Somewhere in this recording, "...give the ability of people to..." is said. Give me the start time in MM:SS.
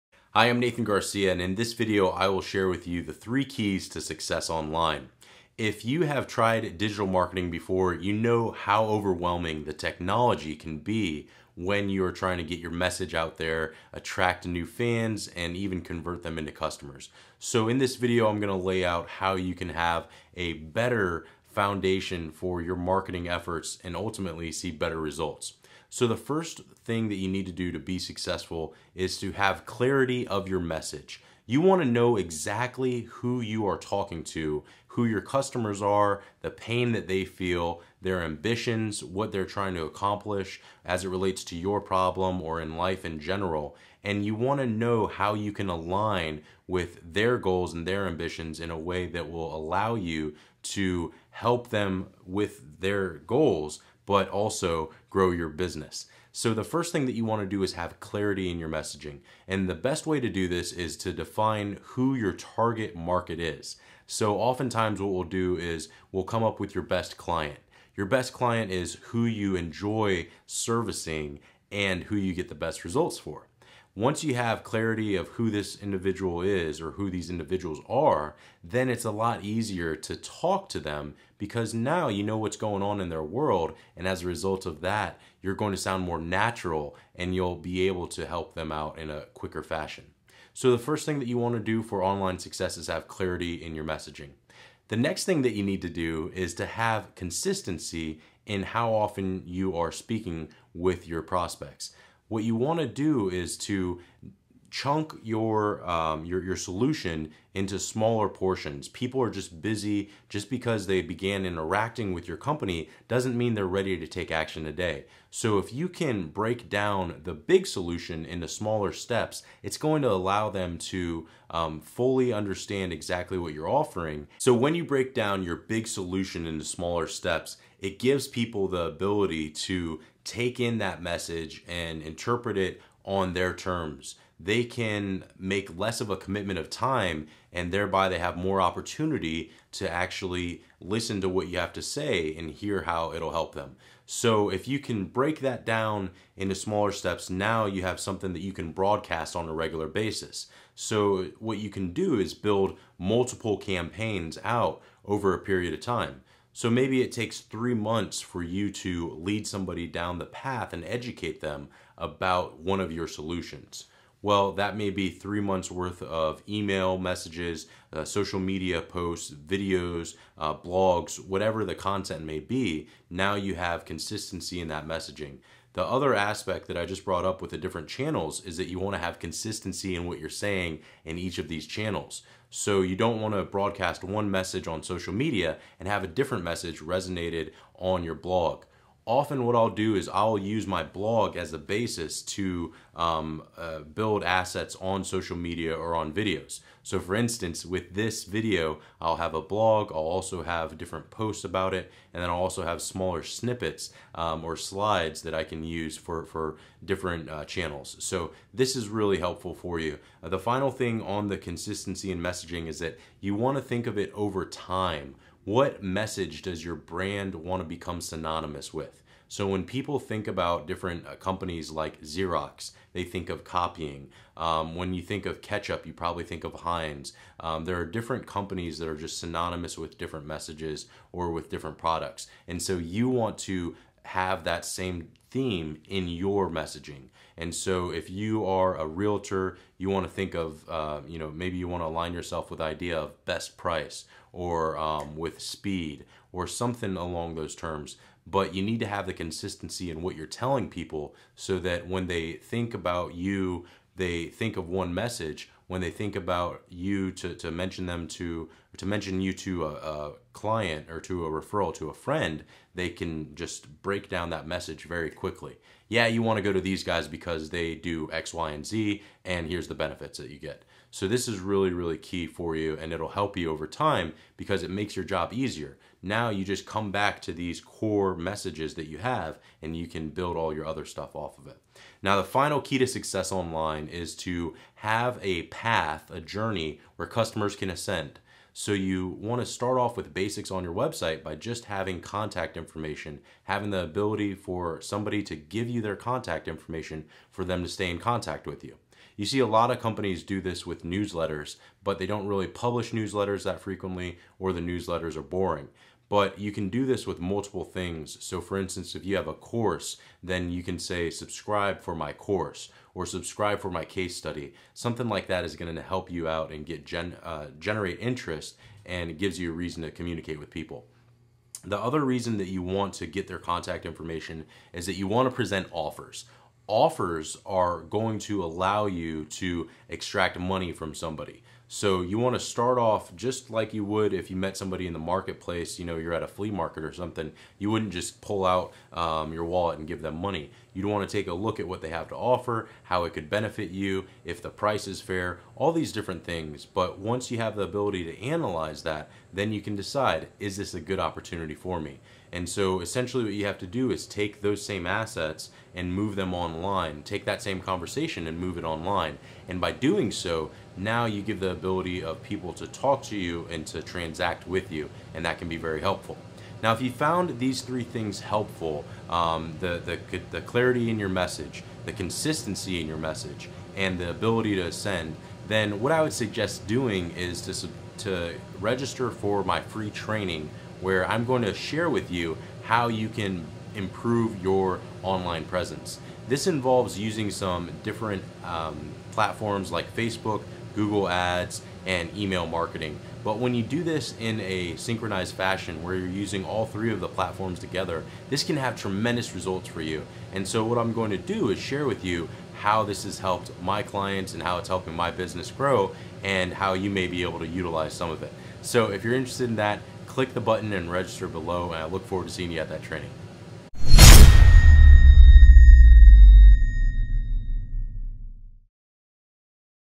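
06:01.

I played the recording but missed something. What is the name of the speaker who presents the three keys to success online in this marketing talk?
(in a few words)
Nathan Garcia.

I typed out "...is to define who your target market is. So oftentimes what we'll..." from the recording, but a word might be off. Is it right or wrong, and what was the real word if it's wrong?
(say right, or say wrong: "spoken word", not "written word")
right.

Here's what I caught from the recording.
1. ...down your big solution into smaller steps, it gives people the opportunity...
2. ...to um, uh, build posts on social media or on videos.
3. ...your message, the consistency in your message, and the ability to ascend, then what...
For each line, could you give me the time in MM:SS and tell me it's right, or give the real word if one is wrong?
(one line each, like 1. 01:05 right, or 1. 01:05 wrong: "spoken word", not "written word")
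1. 02:05 wrong: "ability", not "opportunity"
2. 03:12 wrong: "assets", not "posts"
3. 06:10 right.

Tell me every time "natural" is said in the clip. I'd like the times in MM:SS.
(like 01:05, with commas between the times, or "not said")
01:26.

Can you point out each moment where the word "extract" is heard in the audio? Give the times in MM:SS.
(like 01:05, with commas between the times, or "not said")
05:29.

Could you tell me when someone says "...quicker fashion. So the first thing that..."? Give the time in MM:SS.
01:29.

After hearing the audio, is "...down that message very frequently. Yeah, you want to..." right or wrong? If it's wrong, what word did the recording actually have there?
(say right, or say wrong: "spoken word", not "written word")
wrong: "quickly", not "frequently".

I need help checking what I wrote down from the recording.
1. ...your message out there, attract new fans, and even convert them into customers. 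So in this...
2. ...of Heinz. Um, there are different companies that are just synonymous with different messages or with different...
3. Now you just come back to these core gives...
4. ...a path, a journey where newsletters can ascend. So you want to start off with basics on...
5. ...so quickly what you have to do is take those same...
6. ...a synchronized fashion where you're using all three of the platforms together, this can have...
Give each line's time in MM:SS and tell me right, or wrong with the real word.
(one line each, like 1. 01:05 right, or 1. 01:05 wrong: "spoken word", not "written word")
1. 00:12 right
2. 03:46 right
3. 04:36 wrong: "messages", not "gives"
4. 04:45 wrong: "customers", not "newsletters"
5. 05:52 wrong: "essentially", not "quickly"
6. 06:34 right.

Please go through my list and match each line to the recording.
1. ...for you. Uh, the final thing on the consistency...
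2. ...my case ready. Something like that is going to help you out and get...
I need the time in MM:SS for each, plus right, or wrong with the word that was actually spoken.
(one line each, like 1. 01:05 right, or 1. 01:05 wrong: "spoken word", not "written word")
1. 03:29 right
2. 05:13 wrong: "study", not "ready".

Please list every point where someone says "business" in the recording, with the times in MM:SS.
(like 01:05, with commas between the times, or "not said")
00:55, 06:45.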